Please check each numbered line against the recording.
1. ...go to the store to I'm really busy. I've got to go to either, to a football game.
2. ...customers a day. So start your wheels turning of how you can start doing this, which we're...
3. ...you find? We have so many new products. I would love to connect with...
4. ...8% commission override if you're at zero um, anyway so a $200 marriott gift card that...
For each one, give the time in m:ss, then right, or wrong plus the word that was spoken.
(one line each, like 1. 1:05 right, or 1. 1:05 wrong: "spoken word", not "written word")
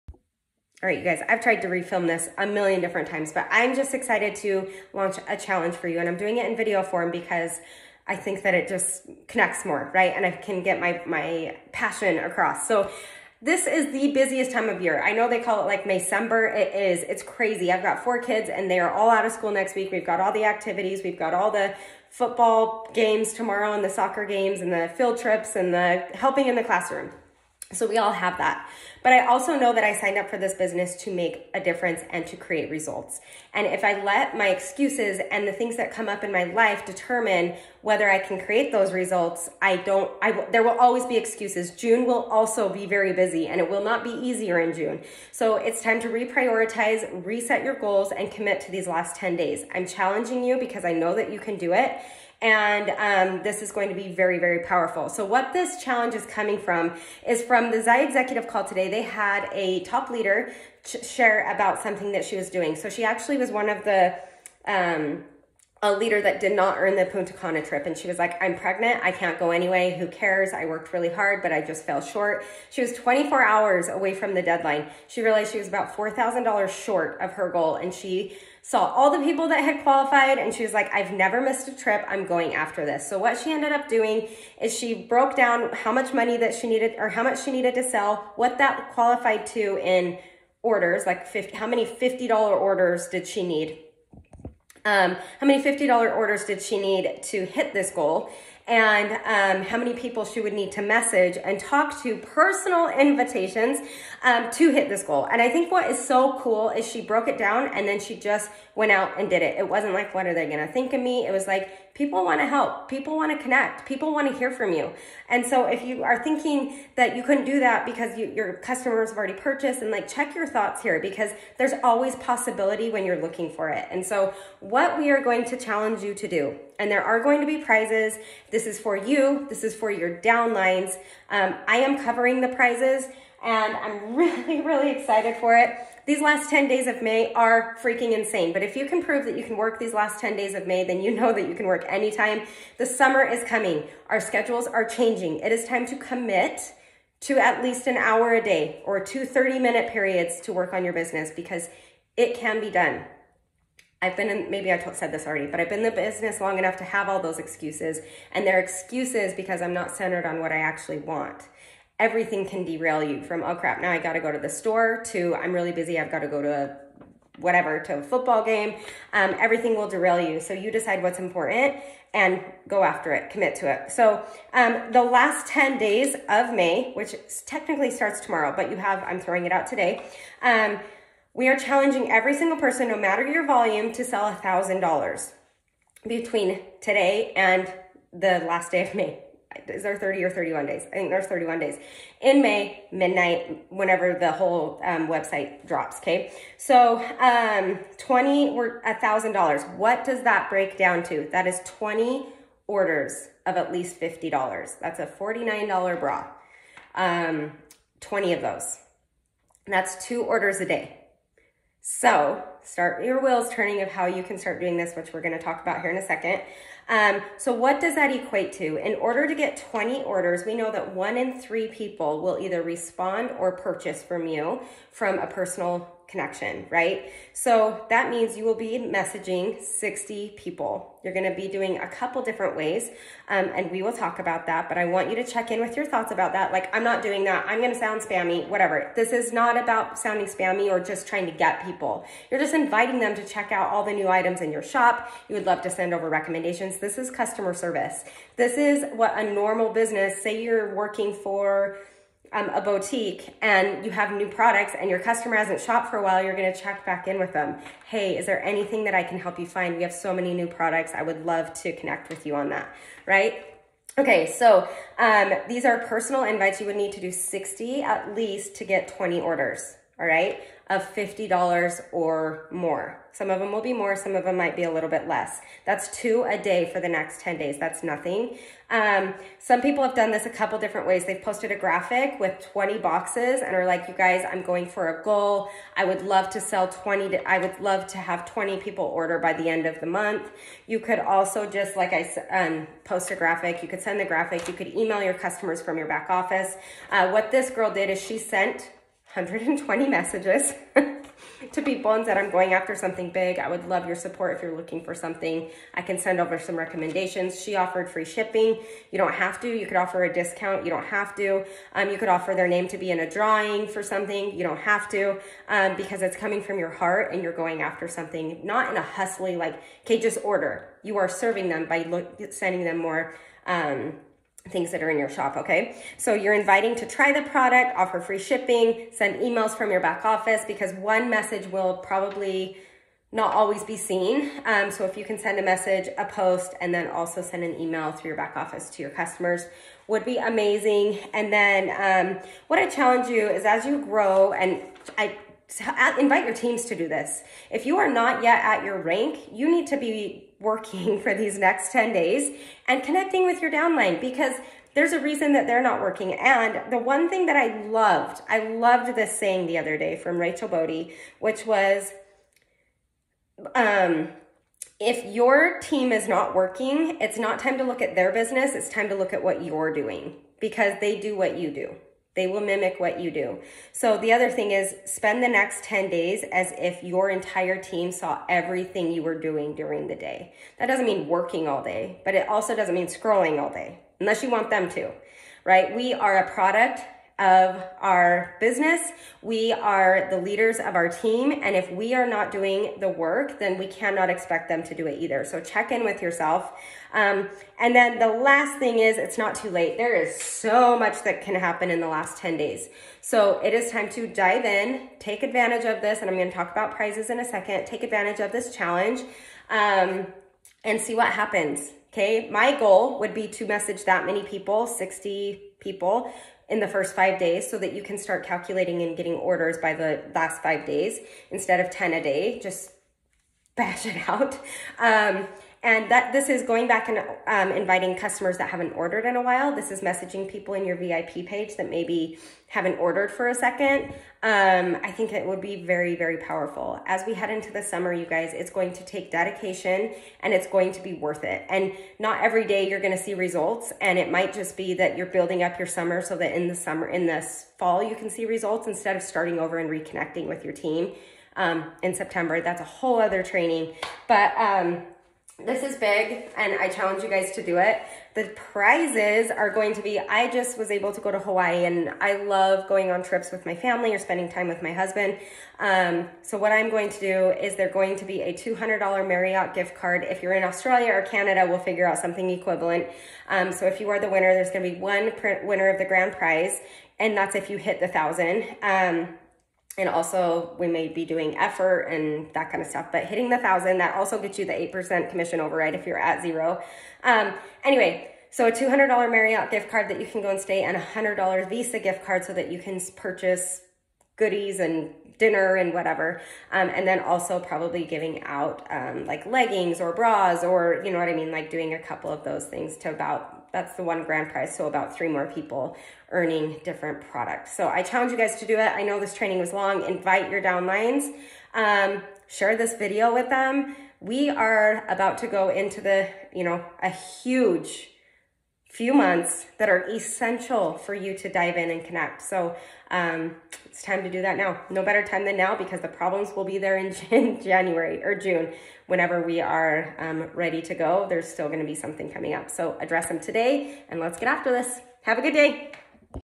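1. 2:44 wrong: "whatever", not "either"
2. 3:30 wrong: "orders", not "customers"
3. 4:19 right
4. 8:04 right.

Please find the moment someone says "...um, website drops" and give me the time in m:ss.
3:14.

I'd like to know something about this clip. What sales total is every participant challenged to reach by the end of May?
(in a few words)
$1,000.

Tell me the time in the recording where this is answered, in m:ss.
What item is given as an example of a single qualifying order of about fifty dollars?
3:25.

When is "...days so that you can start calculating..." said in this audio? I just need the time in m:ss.
6:57.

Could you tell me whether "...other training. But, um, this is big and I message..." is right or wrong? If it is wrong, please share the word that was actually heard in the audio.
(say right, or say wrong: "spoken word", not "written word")
wrong: "challenge", not "message".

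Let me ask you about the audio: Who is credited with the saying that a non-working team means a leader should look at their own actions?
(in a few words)
Rachel Bodie.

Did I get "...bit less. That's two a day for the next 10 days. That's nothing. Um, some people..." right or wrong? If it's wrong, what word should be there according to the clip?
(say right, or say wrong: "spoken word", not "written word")
right.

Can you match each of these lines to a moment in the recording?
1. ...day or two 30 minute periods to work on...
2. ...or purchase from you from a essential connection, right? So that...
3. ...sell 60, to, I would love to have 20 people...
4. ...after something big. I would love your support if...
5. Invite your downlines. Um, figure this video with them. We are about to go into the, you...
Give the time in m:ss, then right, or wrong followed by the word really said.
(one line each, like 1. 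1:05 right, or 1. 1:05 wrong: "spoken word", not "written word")
1. 2:28 right
2. 3:43 wrong: "personal", not "essential"
3. 4:46 wrong: "20", not "60"
4. 5:02 right
5. 8:29 wrong: "share", not "figure".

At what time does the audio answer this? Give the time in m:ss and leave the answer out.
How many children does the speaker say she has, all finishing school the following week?
0:18.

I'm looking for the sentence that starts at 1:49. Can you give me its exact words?
It wasn't like, what are they going to think of me?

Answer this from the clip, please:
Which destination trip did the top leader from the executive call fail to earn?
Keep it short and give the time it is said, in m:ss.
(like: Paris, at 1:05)
Punta Cana, at 1:07.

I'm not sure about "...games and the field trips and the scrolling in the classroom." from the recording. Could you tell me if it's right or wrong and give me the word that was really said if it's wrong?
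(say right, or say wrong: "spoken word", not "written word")
wrong: "helping", not "scrolling".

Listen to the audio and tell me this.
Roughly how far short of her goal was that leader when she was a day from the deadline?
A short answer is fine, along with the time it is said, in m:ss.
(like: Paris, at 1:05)
$4,000, at 1:15.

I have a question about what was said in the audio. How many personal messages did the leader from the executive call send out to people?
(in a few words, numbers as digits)
120.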